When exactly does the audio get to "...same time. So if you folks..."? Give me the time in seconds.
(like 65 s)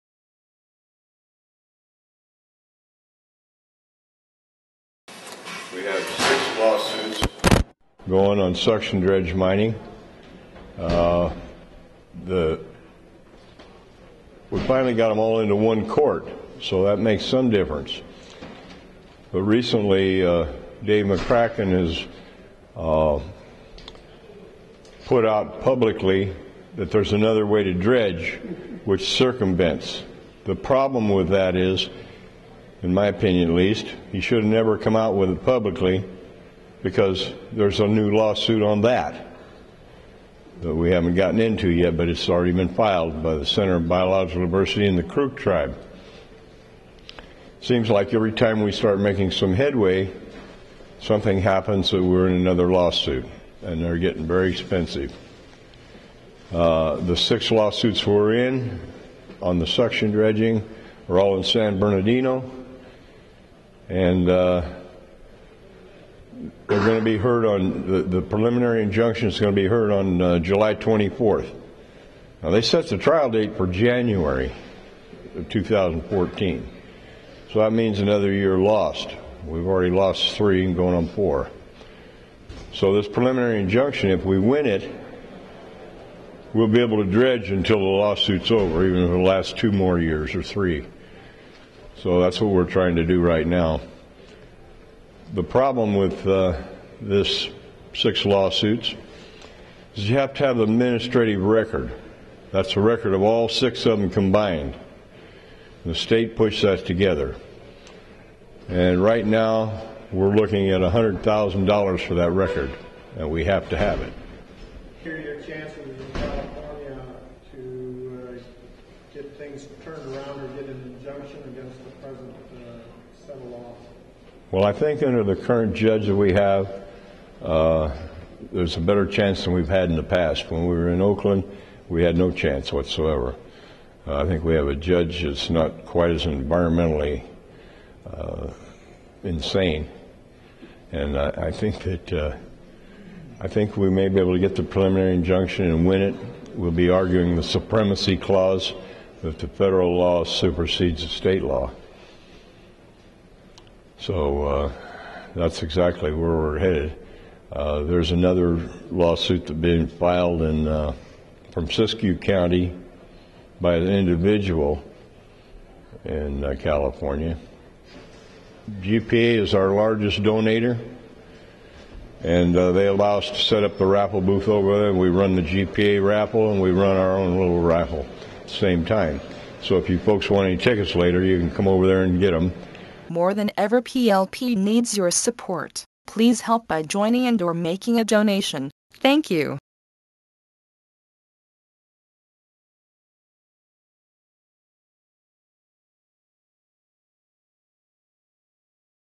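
178 s.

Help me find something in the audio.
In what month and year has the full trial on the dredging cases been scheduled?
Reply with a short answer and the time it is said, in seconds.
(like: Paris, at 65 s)
January 2014, at 73 s.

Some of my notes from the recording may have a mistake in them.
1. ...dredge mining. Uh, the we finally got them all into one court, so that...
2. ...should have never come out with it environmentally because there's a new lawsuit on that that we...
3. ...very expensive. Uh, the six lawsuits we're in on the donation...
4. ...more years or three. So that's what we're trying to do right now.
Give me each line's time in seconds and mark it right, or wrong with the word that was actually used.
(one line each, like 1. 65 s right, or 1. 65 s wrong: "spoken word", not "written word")
1. 8 s right
2. 34 s wrong: "publicly", not "environmentally"
3. 54 s wrong: "suction", not "donation"
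4. 89 s right.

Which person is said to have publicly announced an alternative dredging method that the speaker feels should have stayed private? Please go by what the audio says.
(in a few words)
Dave McCracken.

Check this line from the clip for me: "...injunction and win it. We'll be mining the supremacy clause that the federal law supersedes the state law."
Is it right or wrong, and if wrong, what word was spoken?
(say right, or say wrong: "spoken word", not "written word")
wrong: "arguing", not "mining".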